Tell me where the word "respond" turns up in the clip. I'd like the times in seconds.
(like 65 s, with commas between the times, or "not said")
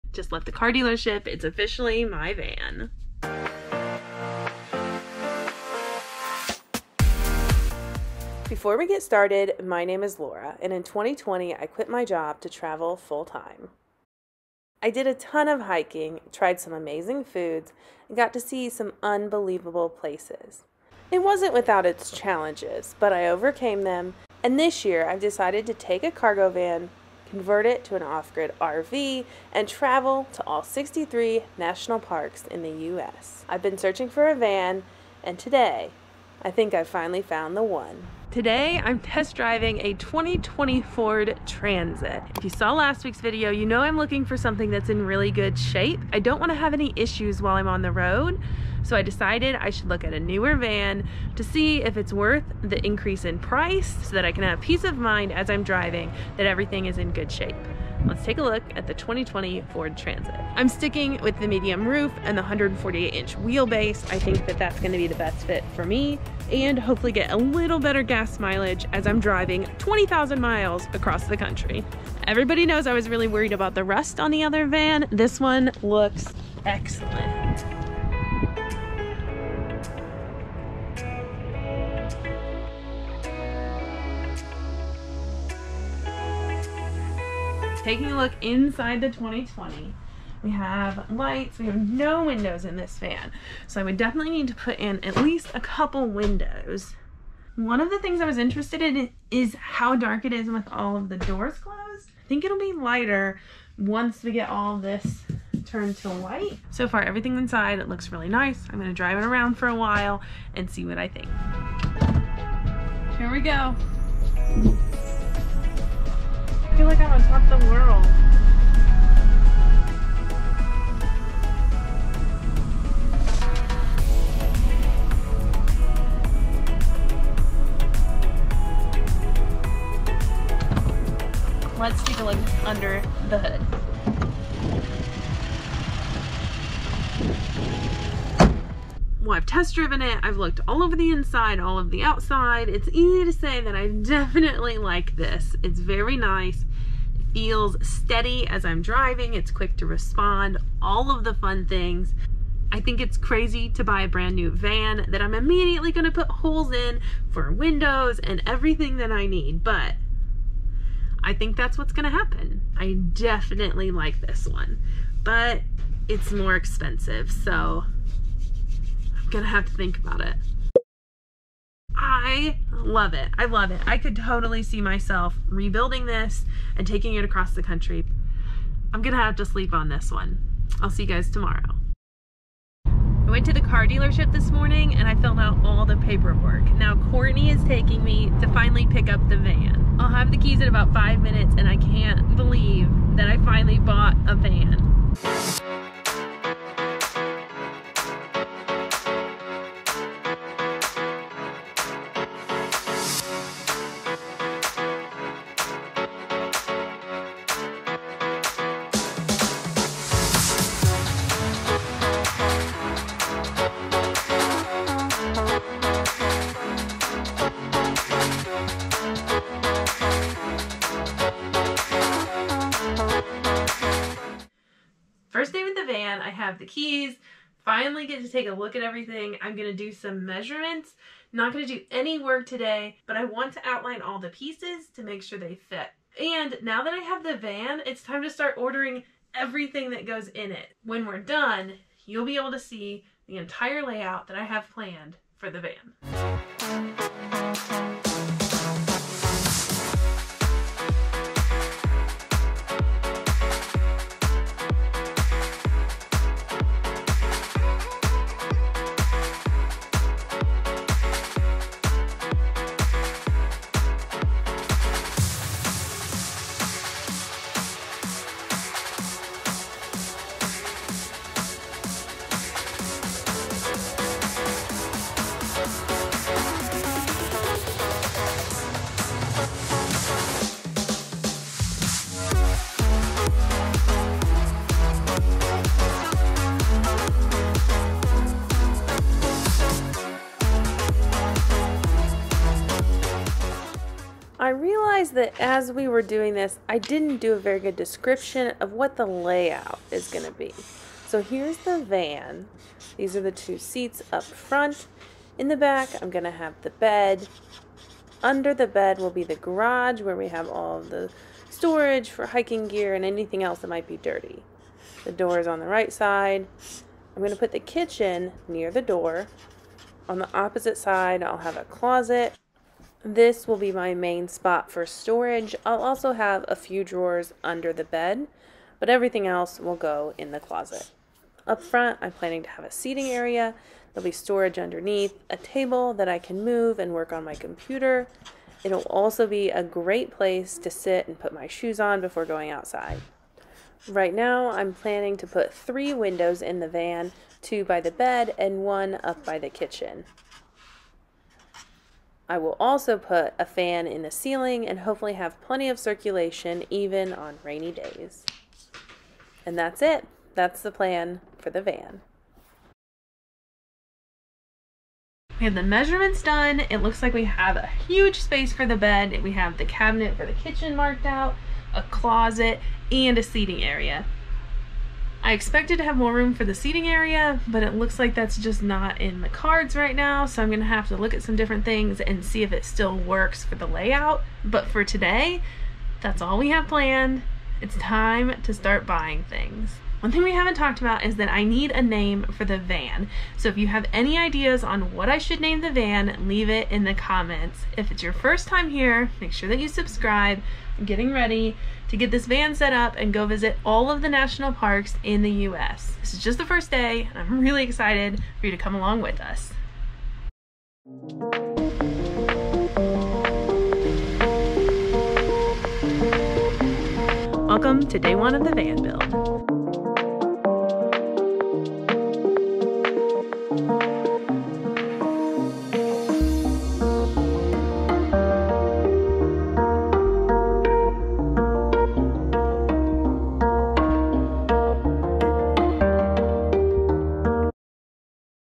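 149 s.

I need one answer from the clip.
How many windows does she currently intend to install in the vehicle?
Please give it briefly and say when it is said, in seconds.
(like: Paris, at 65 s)
3, at 345 s.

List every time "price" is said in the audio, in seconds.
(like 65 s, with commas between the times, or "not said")
53 s.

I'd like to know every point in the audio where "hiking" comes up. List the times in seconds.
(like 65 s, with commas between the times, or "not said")
15 s, 312 s.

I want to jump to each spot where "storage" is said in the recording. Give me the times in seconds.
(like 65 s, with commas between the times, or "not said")
311 s, 324 s, 334 s.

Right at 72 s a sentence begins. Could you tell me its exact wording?
Everybody knows I was really worried about the rust on the other van.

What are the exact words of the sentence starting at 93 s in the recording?
So I would definitely need to put in at least a couple windows.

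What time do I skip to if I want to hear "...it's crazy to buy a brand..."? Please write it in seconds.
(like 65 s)
153 s.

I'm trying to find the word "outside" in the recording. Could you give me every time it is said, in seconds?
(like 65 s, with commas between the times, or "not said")
142 s, 342 s.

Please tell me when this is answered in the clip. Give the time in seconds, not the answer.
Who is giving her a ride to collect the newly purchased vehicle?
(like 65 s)
187 s.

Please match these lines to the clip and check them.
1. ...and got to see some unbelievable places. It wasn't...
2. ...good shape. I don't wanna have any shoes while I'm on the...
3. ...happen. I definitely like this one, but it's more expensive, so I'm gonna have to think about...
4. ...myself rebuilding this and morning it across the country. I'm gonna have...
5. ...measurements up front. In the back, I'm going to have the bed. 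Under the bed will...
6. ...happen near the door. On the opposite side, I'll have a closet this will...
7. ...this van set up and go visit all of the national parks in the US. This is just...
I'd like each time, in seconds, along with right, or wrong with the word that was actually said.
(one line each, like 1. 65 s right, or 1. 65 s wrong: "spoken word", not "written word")
1. 18 s right
2. 45 s wrong: "issues", not "shoes"
3. 162 s right
4. 174 s wrong: "taking", not "morning"
5. 303 s wrong: "seats", not "measurements"
6. 317 s wrong: "kitchen", not "happen"
7. 402 s right.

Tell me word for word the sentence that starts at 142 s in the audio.
It's easy to say that I definitely like this.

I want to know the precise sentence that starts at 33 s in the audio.
I've been searching for a van, and today I think I finally found the one.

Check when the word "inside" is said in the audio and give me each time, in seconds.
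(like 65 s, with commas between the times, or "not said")
88 s, 107 s, 141 s.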